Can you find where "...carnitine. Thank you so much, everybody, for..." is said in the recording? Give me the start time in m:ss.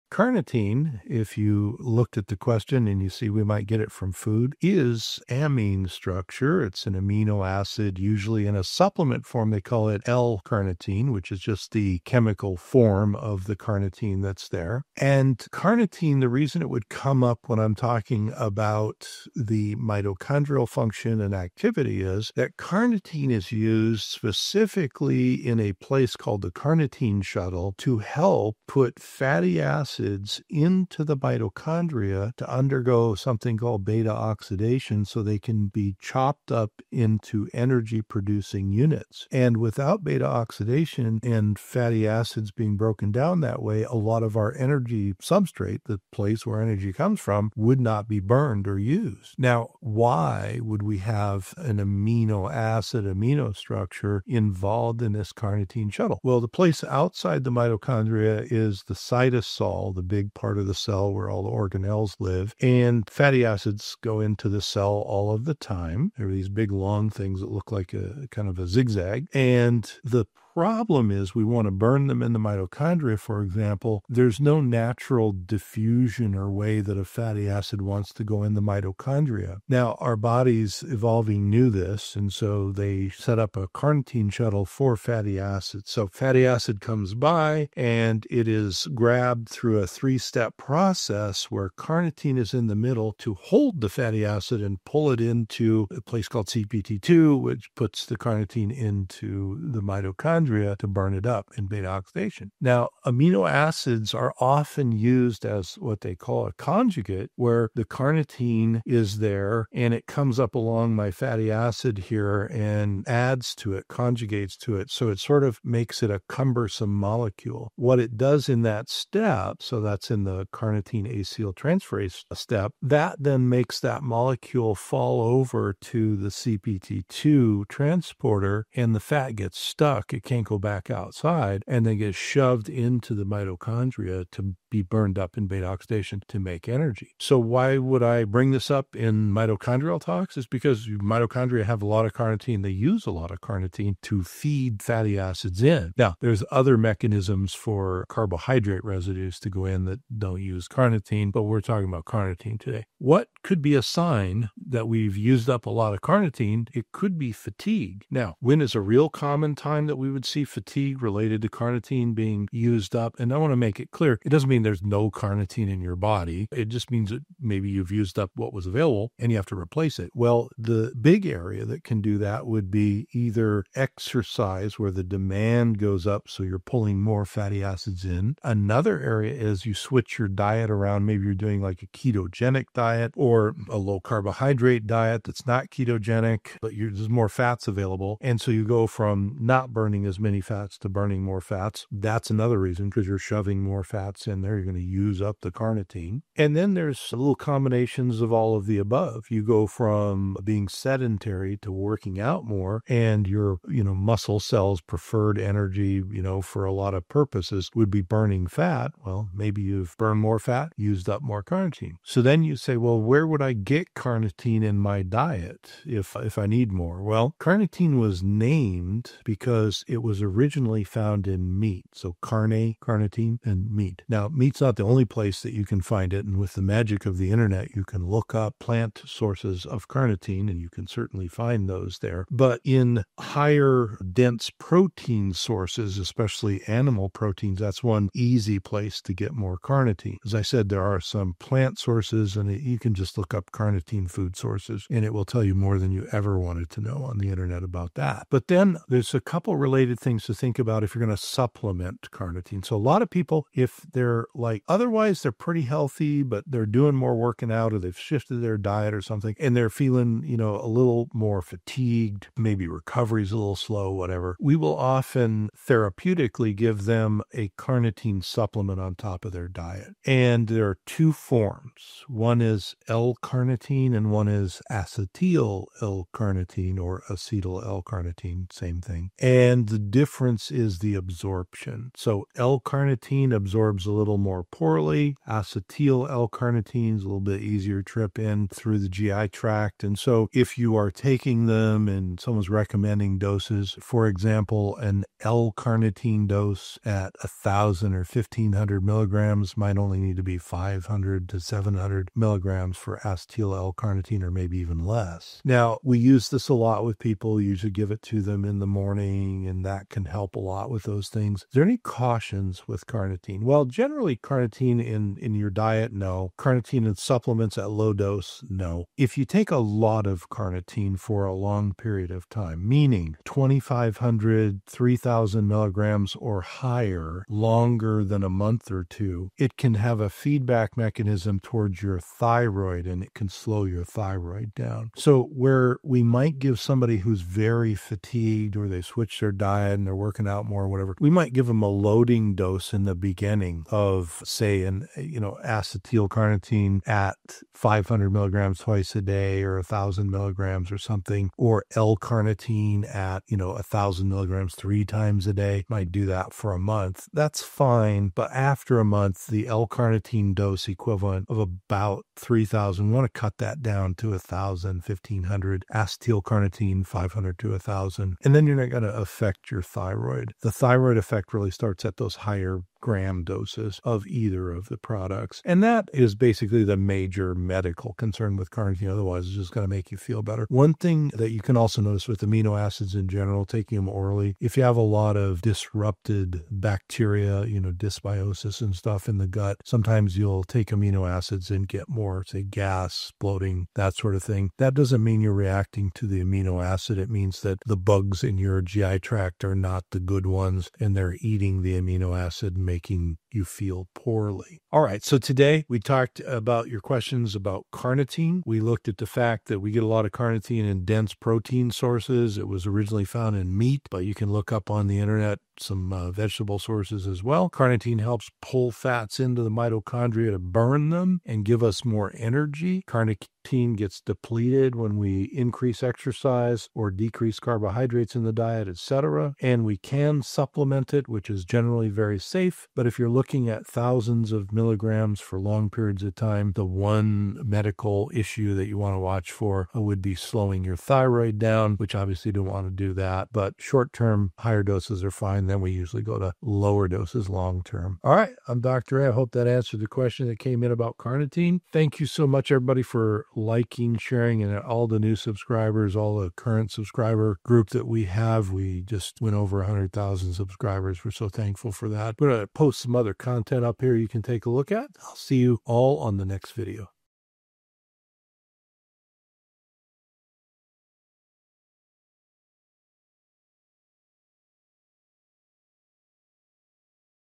7:30.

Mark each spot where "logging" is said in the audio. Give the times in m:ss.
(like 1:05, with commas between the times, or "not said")
not said.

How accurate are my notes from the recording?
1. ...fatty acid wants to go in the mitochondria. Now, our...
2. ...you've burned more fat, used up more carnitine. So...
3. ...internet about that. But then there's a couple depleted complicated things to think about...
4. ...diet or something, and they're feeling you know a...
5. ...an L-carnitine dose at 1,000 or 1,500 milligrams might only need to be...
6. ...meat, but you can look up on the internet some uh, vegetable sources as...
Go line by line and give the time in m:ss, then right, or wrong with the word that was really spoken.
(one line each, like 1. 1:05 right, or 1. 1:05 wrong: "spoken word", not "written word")
1. 1:17 right
2. 3:29 right
3. 4:07 wrong: "related", not "depleted"
4. 4:18 right
5. 4:54 right
6. 6:53 right.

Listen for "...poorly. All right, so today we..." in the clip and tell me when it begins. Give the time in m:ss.
6:43.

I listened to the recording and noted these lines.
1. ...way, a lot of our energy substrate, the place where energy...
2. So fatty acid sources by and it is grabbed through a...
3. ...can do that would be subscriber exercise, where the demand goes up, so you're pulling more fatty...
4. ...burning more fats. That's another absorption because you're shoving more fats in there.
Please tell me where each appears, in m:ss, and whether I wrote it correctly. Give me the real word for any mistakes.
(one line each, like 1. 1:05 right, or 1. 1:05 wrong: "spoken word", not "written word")
1. 0:43 right
2. 1:25 wrong: "comes", not "sources"
3. 2:51 wrong: "either", not "subscriber"
4. 3:10 wrong: "reason", not "absorption".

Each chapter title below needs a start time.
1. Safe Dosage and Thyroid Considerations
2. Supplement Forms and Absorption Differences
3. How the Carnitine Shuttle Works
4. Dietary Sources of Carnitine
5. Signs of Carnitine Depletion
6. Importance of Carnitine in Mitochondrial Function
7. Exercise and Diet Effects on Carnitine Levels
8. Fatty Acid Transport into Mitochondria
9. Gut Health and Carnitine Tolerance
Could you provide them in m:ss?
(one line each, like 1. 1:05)
1. 5:06
2. 4:01
3. 0:37
4. 3:44
5. 2:38
6. 2:19
7. 3:00
8. 1:27
9. 6:20.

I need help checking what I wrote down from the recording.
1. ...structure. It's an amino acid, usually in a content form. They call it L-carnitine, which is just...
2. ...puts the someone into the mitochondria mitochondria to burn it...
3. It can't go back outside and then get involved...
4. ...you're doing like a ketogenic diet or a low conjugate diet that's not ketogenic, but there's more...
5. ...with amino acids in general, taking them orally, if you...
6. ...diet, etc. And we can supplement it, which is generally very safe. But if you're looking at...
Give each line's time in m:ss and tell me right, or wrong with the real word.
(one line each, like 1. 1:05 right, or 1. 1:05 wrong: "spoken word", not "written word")
1. 0:05 wrong: "supplement", not "content"
2. 1:37 wrong: "carnitine", not "someone"
3. 2:10 wrong: "shoved", not "involved"
4. 3:01 wrong: "carbohydrate", not "conjugate"
5. 6:22 right
6. 7:08 right.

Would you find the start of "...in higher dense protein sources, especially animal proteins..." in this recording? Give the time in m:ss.
3:52.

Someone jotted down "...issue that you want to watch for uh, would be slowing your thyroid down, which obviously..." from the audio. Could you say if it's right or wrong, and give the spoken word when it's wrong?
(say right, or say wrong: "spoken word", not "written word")
right.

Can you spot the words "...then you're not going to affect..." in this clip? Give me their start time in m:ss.
6:08.